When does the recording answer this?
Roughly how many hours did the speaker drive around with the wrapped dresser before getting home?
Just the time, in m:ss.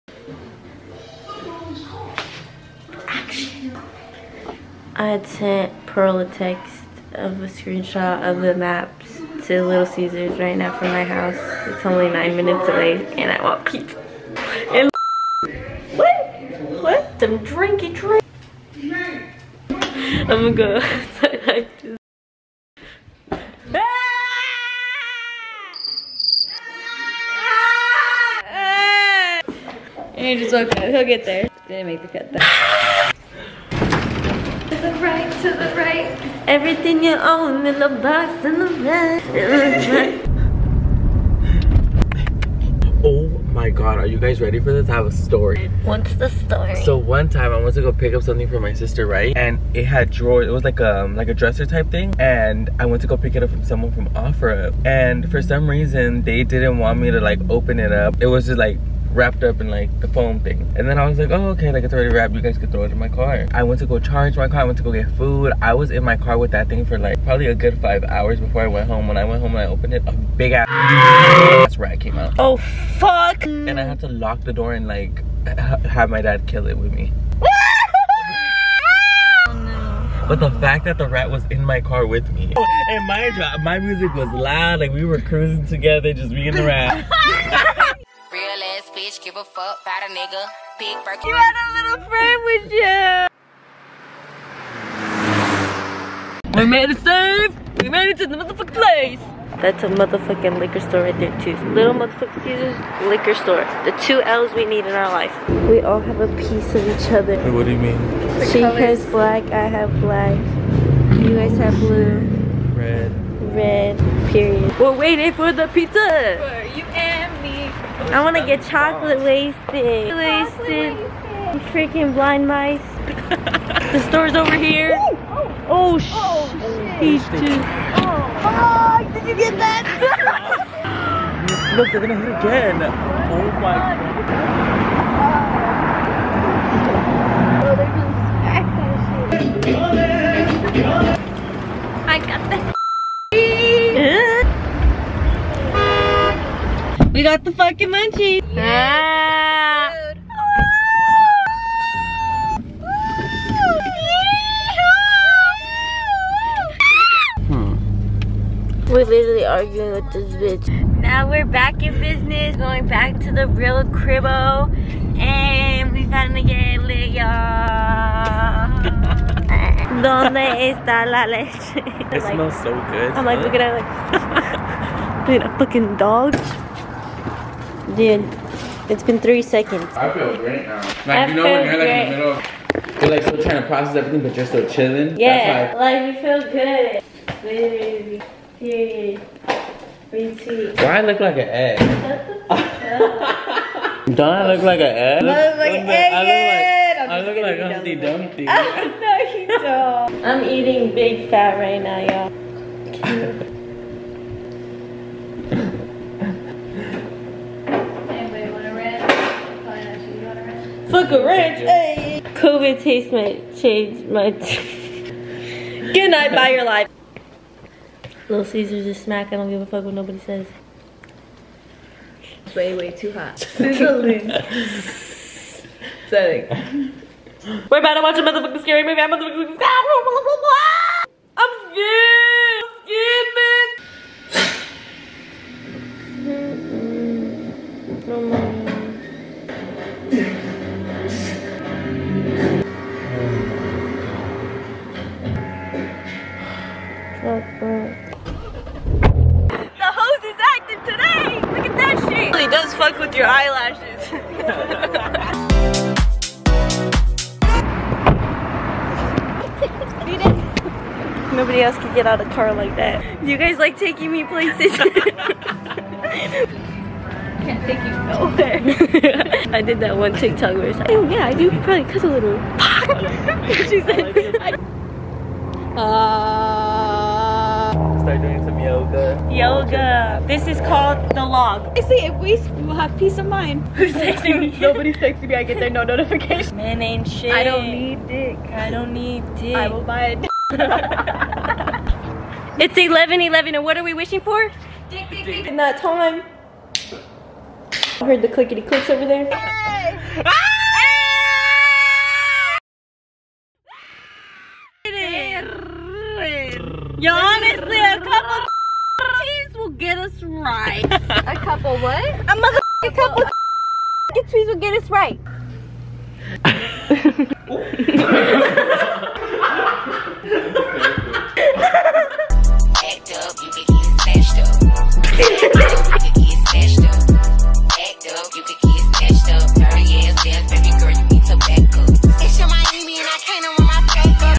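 1:07.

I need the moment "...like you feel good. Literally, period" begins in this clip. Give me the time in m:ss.
3:05.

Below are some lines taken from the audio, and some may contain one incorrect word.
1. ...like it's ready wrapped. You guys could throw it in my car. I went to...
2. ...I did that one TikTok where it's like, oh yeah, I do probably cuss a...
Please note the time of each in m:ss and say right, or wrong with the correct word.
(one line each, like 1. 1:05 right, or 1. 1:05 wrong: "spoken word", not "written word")
1. 1:01 wrong: "already", not "ready"
2. 4:29 right.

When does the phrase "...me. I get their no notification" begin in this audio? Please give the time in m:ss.
4:45.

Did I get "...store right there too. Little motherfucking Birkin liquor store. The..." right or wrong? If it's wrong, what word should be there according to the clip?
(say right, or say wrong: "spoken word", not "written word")
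wrong: "Caesars", not "Birkin".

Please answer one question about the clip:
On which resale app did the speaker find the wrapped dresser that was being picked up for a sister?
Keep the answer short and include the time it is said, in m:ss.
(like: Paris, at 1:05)
OfferUp, at 0:54.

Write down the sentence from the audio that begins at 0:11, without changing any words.
It's only nine minutes away and I want pizza.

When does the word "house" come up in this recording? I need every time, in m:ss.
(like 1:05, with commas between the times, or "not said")
0:11.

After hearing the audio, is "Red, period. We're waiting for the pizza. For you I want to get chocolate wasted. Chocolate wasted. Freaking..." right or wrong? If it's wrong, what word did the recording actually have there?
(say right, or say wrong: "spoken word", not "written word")
right.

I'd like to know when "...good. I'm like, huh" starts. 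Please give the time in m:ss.
2:52.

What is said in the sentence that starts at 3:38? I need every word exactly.
Little Caesars is smack, I don't give a fuck what nobody says.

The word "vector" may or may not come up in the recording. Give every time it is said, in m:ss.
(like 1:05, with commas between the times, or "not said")
not said.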